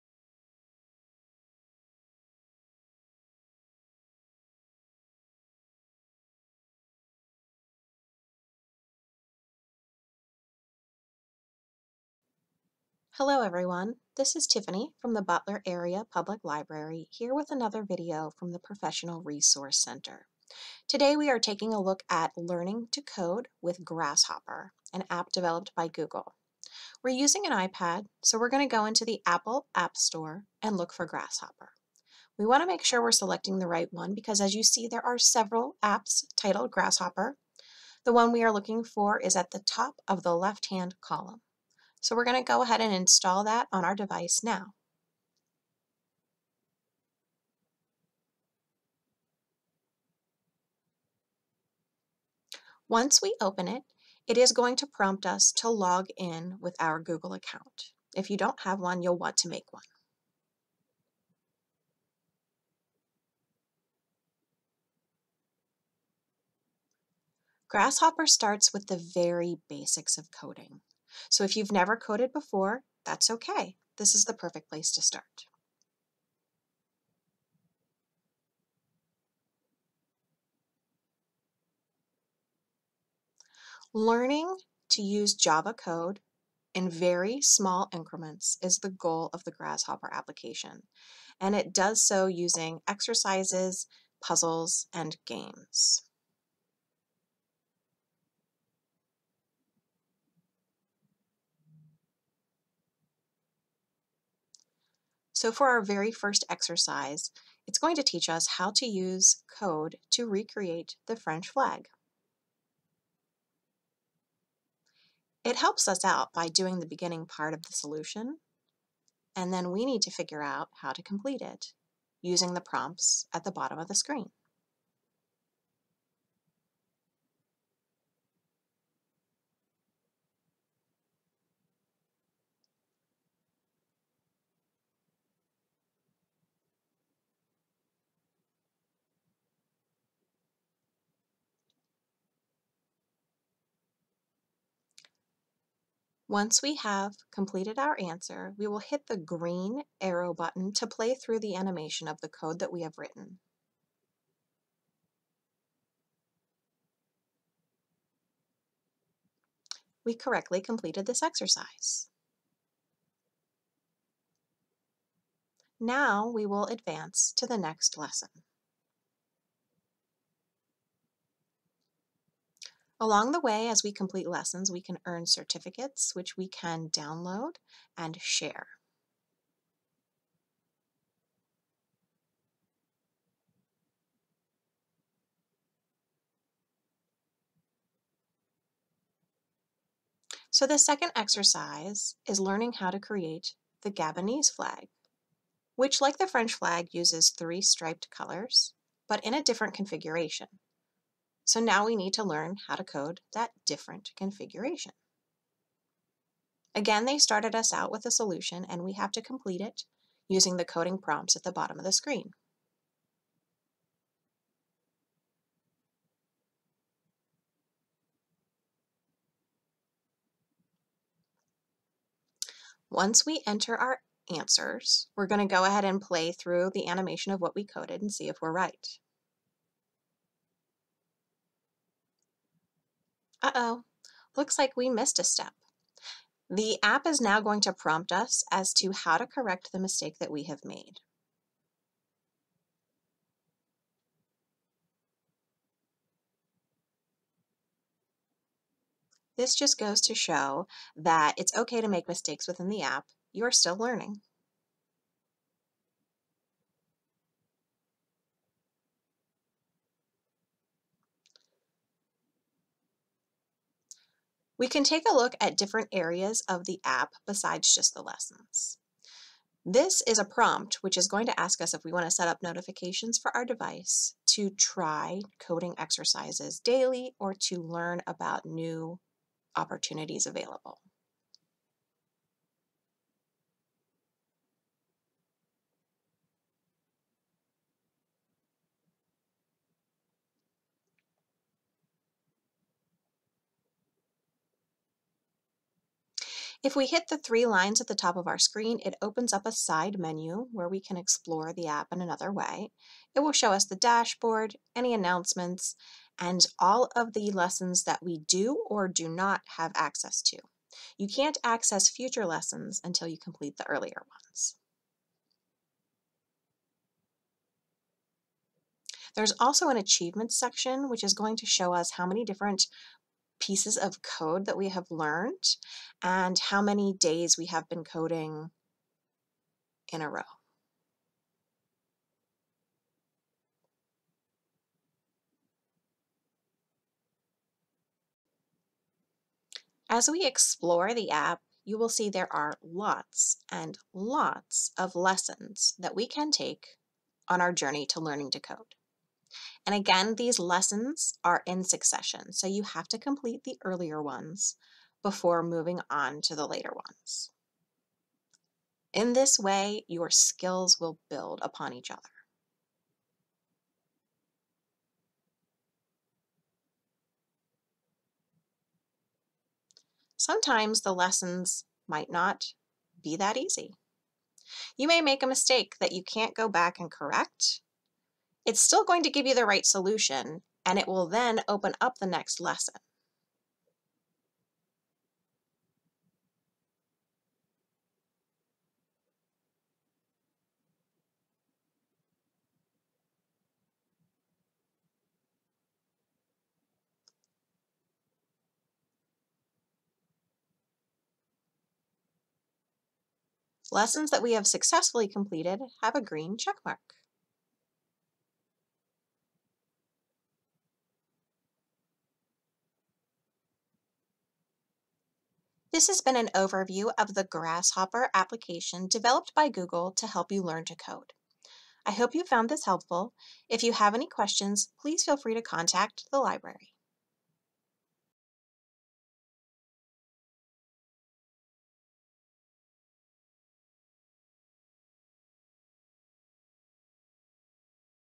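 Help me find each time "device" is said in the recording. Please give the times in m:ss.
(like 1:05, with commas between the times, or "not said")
0:43, 4:33.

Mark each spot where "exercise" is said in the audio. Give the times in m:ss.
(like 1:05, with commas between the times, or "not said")
1:32, 1:46, 2:41, 3:11, 4:35.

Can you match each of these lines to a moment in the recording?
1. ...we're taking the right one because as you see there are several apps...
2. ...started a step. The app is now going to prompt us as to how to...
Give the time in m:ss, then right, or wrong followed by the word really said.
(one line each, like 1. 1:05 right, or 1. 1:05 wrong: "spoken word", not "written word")
1. 0:33 wrong: "selecting", not "taking"
2. 3:54 wrong: "missed", not "started".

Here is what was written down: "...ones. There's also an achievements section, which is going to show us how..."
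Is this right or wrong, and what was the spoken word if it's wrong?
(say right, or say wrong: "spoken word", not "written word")
right.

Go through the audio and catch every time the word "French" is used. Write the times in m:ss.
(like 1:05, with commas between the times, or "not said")
1:51, 3:16.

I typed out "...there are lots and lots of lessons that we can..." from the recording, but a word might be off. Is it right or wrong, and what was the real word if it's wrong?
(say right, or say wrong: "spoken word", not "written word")
right.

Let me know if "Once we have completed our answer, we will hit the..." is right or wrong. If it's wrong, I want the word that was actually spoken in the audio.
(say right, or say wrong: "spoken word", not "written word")
right.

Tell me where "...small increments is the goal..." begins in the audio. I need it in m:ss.
1:27.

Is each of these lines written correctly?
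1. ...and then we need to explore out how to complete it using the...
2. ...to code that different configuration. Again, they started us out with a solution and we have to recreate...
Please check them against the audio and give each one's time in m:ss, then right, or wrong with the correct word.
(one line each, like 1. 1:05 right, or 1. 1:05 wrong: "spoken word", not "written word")
1. 1:59 wrong: "figure", not "explore"
2. 3:22 wrong: "complete", not "recreate".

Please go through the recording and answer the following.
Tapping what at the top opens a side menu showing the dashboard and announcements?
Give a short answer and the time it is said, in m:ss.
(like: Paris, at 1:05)
Three lines, at 4:57.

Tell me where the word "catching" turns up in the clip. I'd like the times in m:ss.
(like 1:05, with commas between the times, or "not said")
not said.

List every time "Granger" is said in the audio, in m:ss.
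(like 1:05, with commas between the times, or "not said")
not said.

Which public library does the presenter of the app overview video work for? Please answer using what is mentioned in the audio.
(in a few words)
Butler Area Public Library.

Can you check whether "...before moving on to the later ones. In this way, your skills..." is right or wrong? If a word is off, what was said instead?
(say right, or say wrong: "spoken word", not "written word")
right.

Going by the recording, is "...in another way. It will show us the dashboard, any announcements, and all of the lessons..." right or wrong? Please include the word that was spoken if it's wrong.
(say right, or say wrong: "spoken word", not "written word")
right.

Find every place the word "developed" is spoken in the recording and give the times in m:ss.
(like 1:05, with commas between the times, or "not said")
0:25, 6:58.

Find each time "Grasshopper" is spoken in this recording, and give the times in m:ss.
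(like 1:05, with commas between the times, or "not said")
0:23, 0:31, 0:36, 1:07, 1:29, 6:57.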